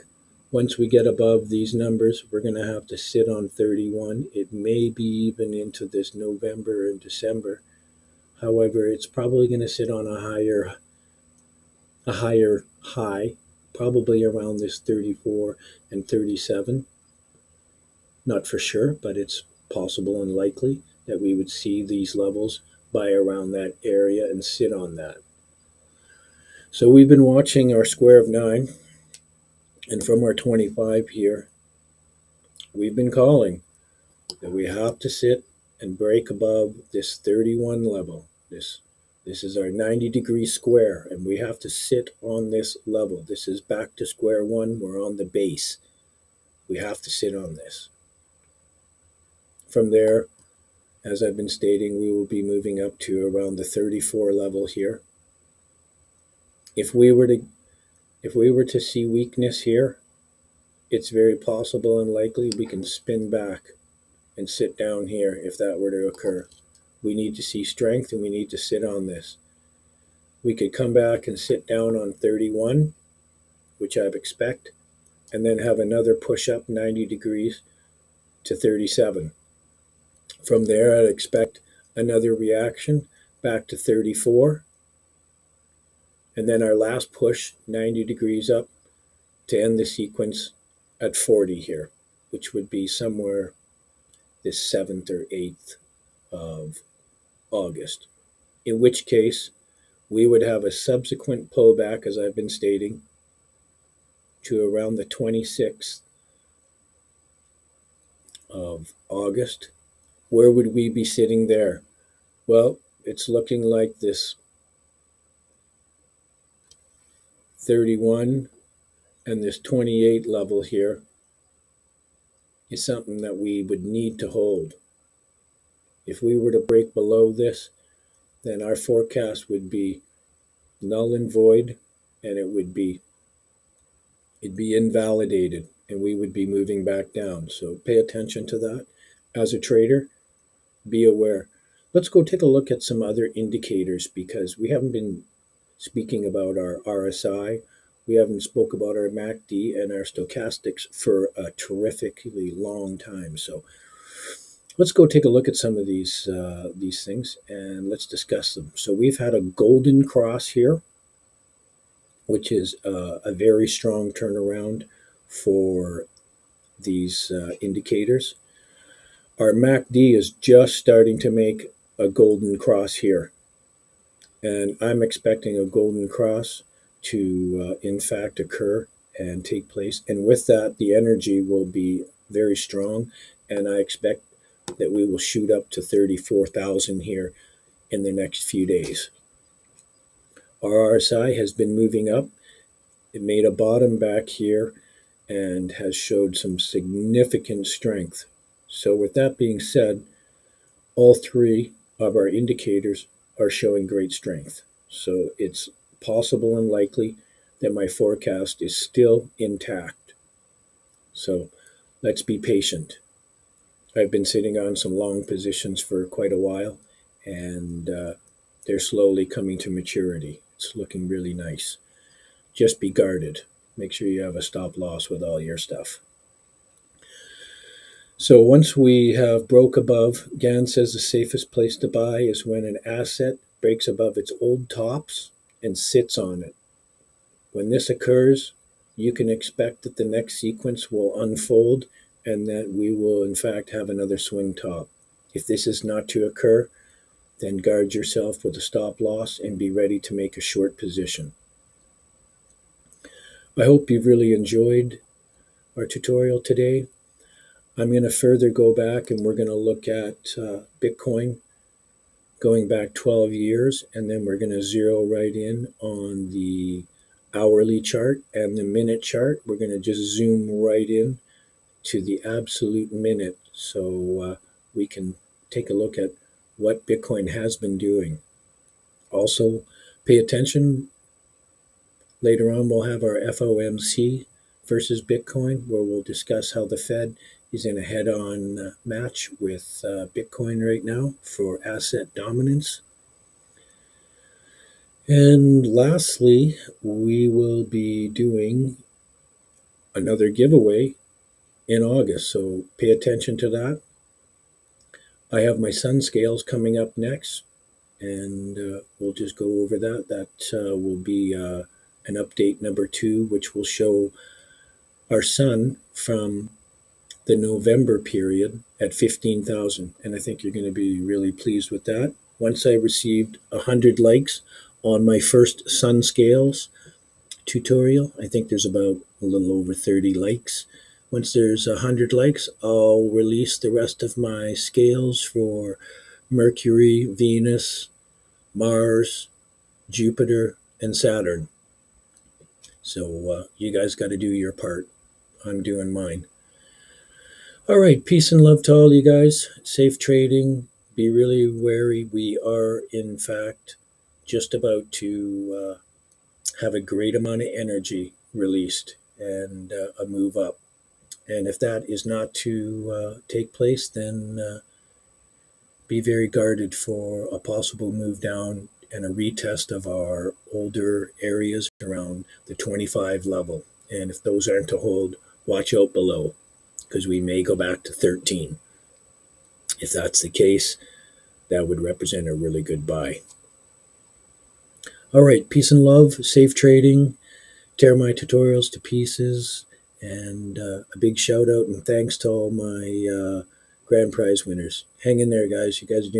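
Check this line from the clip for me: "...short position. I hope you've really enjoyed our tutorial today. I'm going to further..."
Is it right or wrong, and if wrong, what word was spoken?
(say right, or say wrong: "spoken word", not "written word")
right.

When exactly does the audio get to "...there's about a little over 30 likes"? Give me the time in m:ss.
5:28.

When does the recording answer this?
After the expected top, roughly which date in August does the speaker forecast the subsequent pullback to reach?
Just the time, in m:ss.
1:45.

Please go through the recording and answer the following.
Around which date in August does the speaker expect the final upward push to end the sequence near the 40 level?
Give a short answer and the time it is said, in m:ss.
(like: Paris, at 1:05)
7th or 8th of August, at 1:34.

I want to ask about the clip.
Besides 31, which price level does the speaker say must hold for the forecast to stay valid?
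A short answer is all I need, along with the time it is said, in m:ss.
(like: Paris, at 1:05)
28, at 1:59.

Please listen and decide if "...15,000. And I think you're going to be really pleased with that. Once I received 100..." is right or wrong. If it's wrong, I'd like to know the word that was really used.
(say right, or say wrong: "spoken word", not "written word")
right.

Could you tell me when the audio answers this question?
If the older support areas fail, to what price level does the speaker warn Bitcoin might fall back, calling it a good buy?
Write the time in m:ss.
6:17.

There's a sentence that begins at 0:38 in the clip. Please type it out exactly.
This, this is our 90 degree square, and we have to sit on this level.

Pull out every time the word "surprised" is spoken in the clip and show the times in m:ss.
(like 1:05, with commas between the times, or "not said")
not said.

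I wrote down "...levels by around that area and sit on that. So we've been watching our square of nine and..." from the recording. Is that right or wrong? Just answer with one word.
right.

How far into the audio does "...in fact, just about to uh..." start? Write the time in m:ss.
5:52.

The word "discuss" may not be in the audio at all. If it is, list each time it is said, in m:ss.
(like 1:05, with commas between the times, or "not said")
2:38, 4:46.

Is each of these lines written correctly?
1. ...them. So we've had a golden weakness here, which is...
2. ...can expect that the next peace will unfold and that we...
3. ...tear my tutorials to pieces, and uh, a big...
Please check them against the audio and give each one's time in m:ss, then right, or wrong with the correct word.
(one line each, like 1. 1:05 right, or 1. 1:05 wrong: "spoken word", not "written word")
1. 2:38 wrong: "cross", not "weakness"
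2. 3:59 wrong: "sequence", not "peace"
3. 6:27 right.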